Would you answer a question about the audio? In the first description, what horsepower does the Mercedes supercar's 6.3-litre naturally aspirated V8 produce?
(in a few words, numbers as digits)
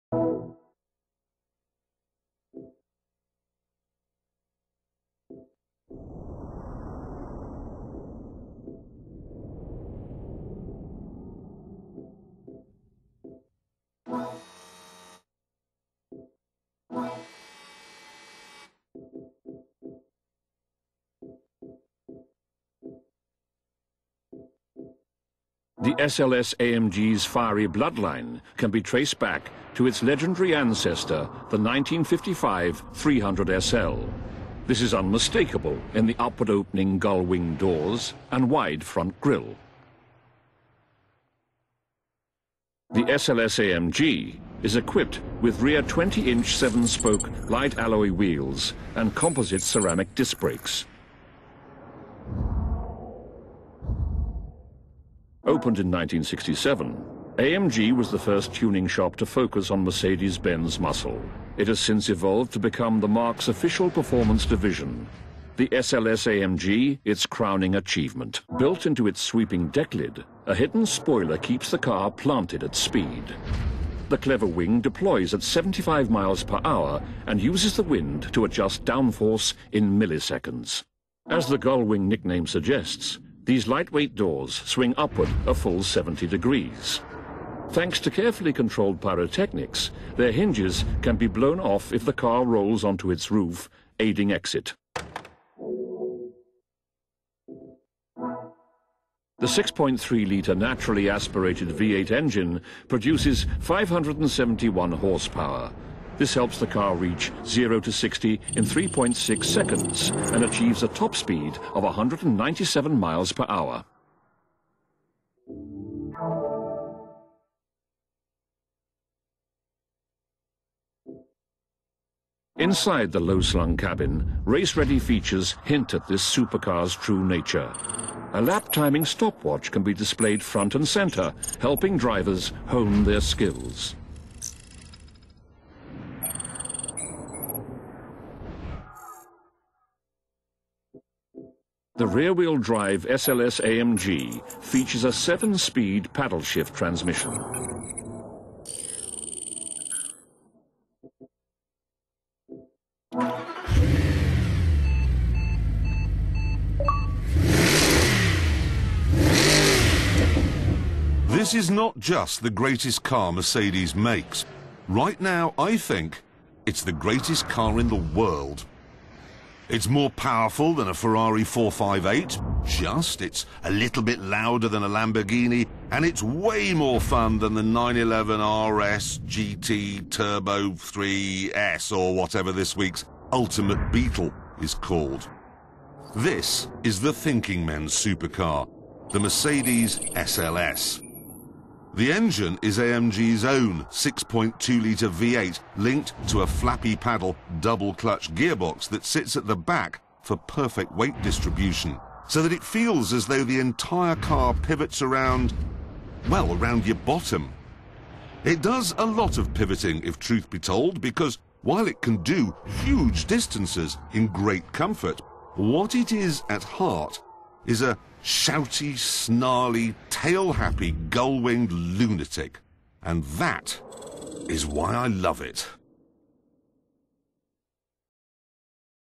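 571.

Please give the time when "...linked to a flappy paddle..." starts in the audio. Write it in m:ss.
3:15.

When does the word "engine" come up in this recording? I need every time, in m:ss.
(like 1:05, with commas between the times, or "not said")
1:42, 3:12.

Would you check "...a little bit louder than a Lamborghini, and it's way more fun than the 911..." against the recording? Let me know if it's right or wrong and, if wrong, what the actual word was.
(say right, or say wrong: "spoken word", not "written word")
right.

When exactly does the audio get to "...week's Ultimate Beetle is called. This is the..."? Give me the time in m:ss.
3:02.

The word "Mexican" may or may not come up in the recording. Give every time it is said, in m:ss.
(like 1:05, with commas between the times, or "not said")
not said.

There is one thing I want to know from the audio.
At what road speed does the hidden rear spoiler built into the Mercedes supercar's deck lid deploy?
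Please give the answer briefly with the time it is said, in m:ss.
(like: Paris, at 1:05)
75 miles per hour, at 1:15.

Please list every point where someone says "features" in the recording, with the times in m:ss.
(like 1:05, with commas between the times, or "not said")
2:04, 2:24.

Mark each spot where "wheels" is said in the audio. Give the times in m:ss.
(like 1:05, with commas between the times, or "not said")
0:48, 2:22.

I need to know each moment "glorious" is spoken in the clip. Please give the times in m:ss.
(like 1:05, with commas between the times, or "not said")
not said.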